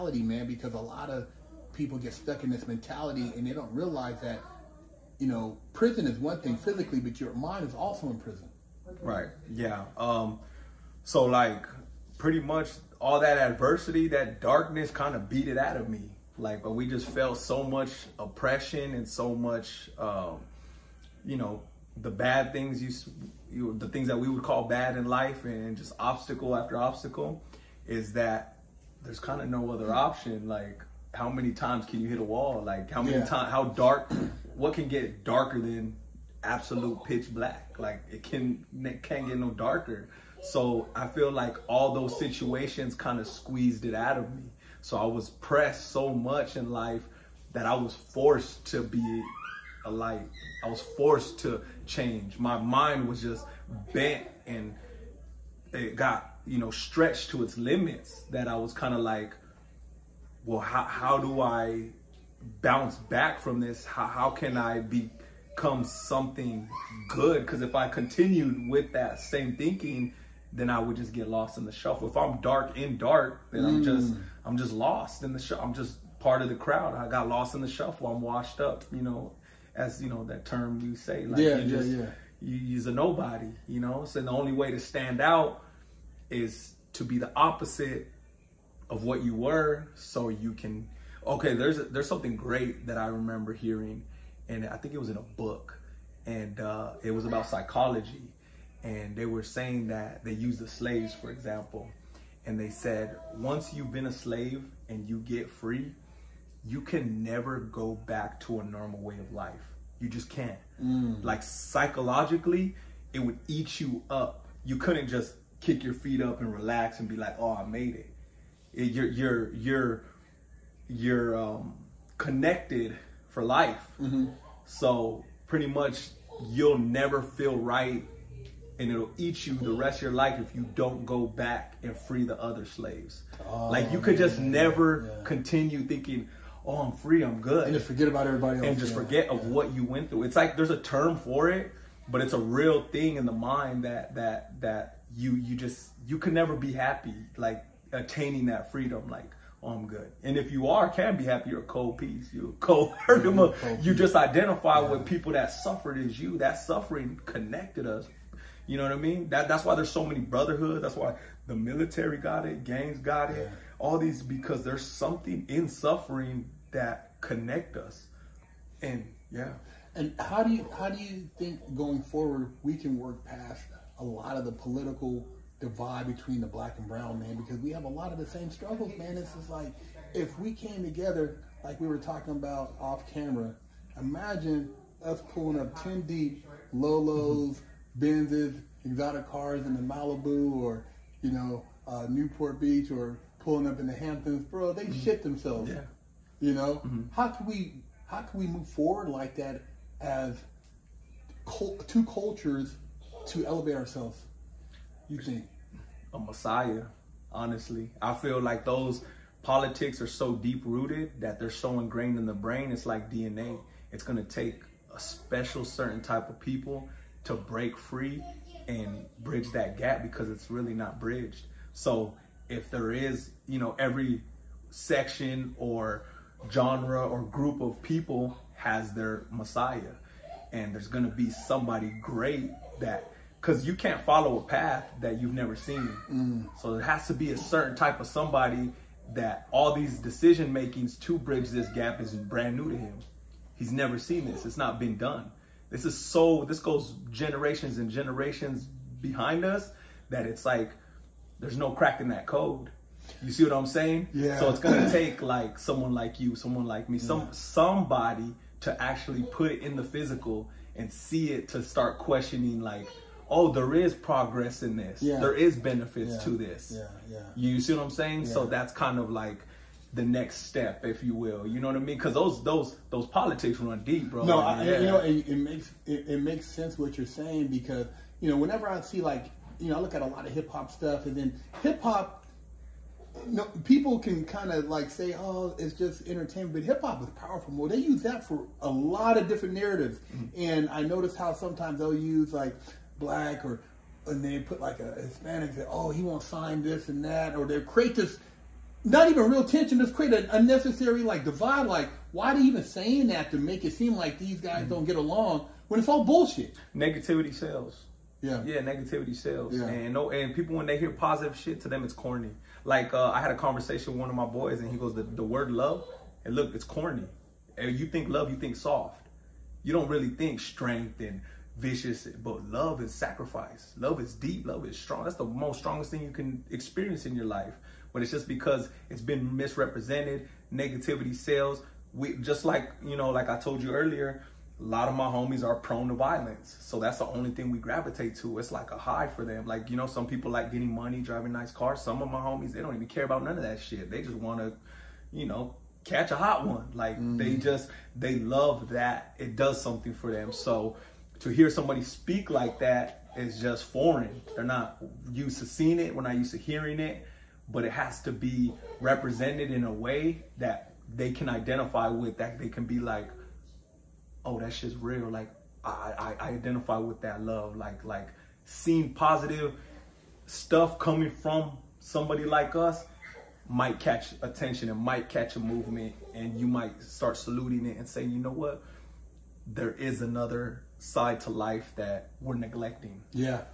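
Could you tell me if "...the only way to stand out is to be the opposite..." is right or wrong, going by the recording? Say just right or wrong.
right.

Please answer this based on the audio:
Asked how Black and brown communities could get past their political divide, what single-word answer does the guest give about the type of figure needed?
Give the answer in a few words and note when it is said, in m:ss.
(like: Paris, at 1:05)
A messiah, at 3:26.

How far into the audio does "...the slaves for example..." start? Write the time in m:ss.
1:40.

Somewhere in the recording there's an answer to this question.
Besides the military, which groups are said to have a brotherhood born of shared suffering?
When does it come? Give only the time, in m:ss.
2:42.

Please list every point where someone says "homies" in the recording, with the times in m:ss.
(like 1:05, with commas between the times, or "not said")
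5:35, 5:42.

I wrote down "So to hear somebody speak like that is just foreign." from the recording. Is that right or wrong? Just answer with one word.
right.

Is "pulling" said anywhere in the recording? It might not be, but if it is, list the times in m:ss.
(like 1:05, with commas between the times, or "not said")
3:05, 3:13.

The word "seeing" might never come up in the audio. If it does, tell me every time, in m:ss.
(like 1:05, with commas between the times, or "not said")
5:55, 6:08.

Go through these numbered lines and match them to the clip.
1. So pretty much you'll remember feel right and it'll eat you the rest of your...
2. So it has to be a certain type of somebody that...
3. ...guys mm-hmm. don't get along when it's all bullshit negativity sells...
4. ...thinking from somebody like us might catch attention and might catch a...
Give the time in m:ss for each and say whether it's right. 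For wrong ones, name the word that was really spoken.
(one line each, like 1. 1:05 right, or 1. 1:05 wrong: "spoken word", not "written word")
1. 2:04 wrong: "never", not "remember"
2. 3:56 right
3. 5:04 right
4. 6:10 wrong: "coming", not "thinking".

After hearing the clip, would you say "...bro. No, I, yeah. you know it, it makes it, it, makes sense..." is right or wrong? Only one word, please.
right.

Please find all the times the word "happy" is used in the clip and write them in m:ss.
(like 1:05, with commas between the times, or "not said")
2:26, 2:31.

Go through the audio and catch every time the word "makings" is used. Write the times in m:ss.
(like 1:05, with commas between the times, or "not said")
4:00.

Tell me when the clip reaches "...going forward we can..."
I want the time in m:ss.
2:51.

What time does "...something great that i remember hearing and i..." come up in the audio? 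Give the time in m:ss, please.
1:32.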